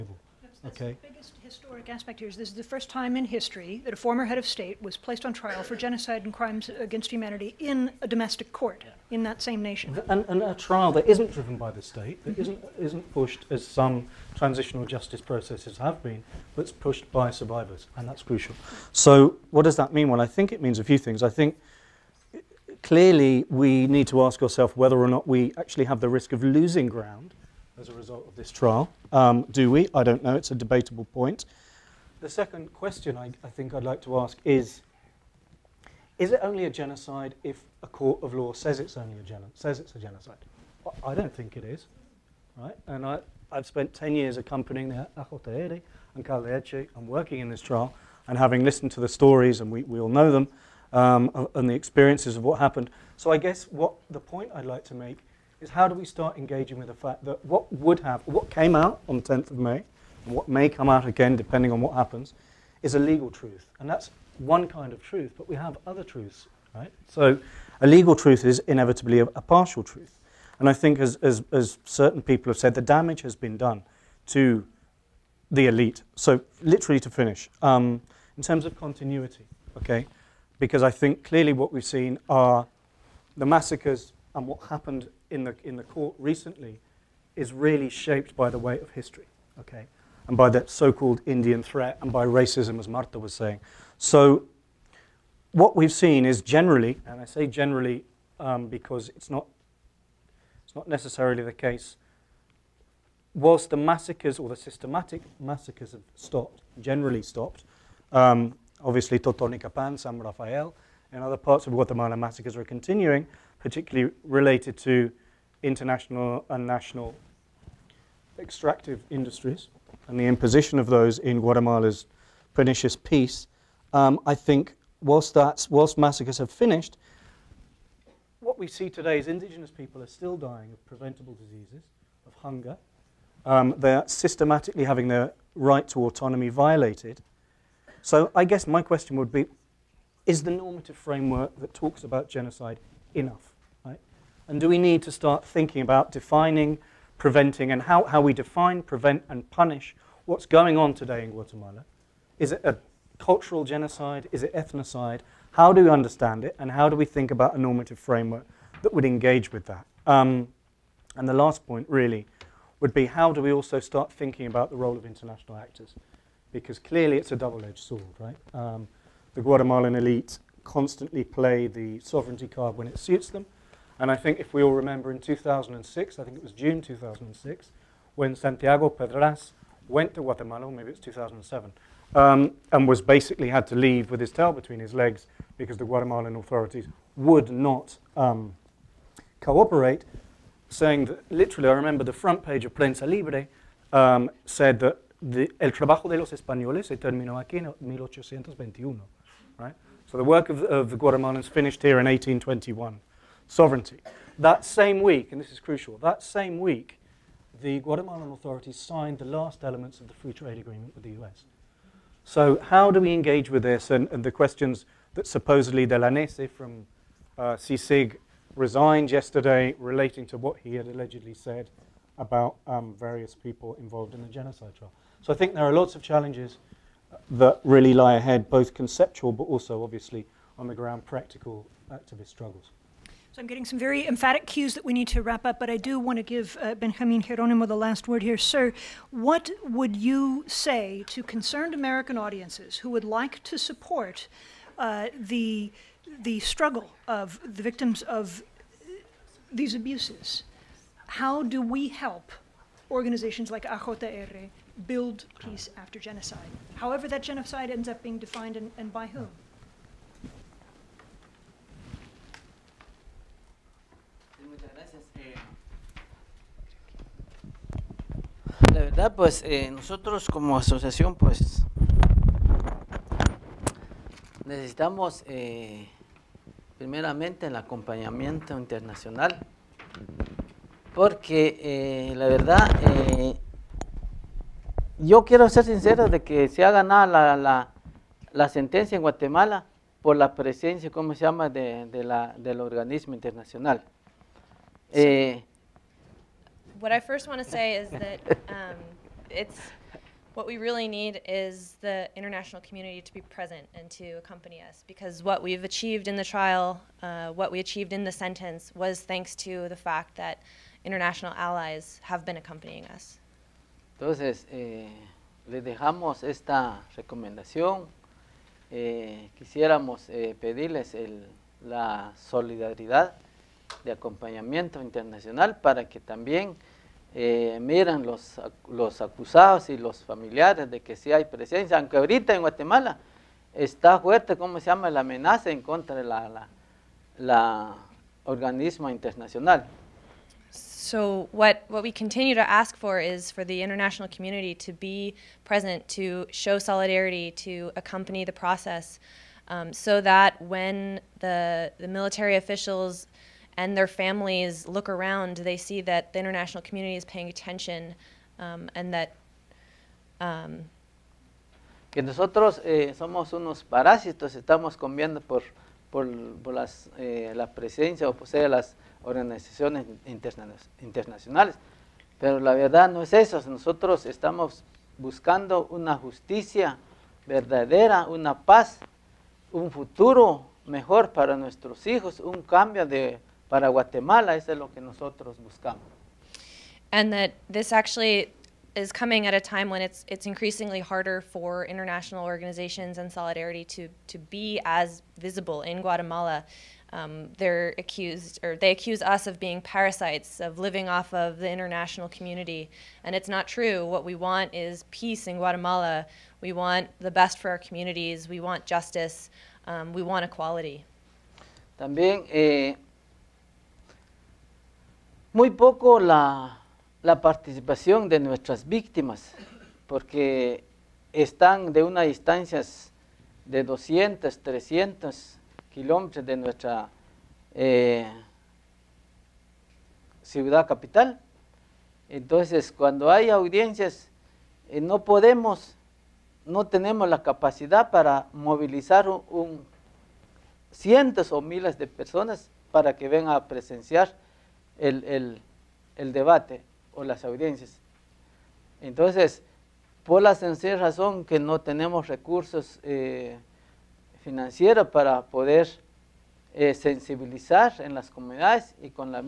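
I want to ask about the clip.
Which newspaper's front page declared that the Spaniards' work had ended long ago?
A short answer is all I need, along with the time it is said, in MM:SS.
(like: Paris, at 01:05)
Prensa Libre, at 03:12.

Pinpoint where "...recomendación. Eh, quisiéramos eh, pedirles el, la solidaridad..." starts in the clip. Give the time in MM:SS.
05:16.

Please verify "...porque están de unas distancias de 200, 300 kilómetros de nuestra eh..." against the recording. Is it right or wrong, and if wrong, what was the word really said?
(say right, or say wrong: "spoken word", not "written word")
right.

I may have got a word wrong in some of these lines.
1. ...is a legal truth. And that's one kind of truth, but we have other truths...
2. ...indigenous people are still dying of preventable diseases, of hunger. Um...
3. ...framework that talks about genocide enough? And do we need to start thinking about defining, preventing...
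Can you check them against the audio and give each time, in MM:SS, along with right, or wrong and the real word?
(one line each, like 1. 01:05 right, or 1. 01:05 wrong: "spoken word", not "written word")
1. 01:02 right
2. 02:09 right
3. 02:20 right.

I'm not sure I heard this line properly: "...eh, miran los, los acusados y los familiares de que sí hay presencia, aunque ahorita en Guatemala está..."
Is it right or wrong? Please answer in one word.
right.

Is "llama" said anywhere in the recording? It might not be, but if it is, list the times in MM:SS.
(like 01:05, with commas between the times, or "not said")
04:51, 05:34.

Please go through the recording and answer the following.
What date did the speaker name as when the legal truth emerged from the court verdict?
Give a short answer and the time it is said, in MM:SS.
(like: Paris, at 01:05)
10th of May, at 00:59.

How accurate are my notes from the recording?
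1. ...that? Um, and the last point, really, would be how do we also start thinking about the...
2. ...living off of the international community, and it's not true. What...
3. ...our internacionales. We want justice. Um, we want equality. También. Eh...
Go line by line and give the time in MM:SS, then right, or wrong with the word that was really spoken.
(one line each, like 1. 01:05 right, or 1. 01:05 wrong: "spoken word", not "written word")
1. 02:39 right
2. 06:40 right
3. 06:47 wrong: "communities", not "internacionales".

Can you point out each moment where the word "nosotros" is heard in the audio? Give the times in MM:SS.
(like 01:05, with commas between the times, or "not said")
04:29, 06:02, 06:13, 06:24.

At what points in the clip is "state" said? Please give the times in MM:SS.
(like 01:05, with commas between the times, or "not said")
00:04, 00:11.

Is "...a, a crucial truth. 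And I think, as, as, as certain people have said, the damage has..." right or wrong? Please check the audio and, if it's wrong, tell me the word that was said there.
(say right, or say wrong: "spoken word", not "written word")
wrong: "partial", not "crucial".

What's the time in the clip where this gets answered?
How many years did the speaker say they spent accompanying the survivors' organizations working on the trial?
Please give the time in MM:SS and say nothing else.
00:43.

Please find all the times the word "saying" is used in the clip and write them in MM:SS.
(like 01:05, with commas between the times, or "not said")
01:33, 03:10.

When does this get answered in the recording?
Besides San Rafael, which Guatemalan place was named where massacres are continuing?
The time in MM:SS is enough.
01:49.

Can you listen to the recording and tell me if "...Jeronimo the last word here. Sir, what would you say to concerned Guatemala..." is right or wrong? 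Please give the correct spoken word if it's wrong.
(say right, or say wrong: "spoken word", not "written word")
wrong: "American", not "Guatemala".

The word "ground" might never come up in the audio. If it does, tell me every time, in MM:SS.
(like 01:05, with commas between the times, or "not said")
00:26, 03:50.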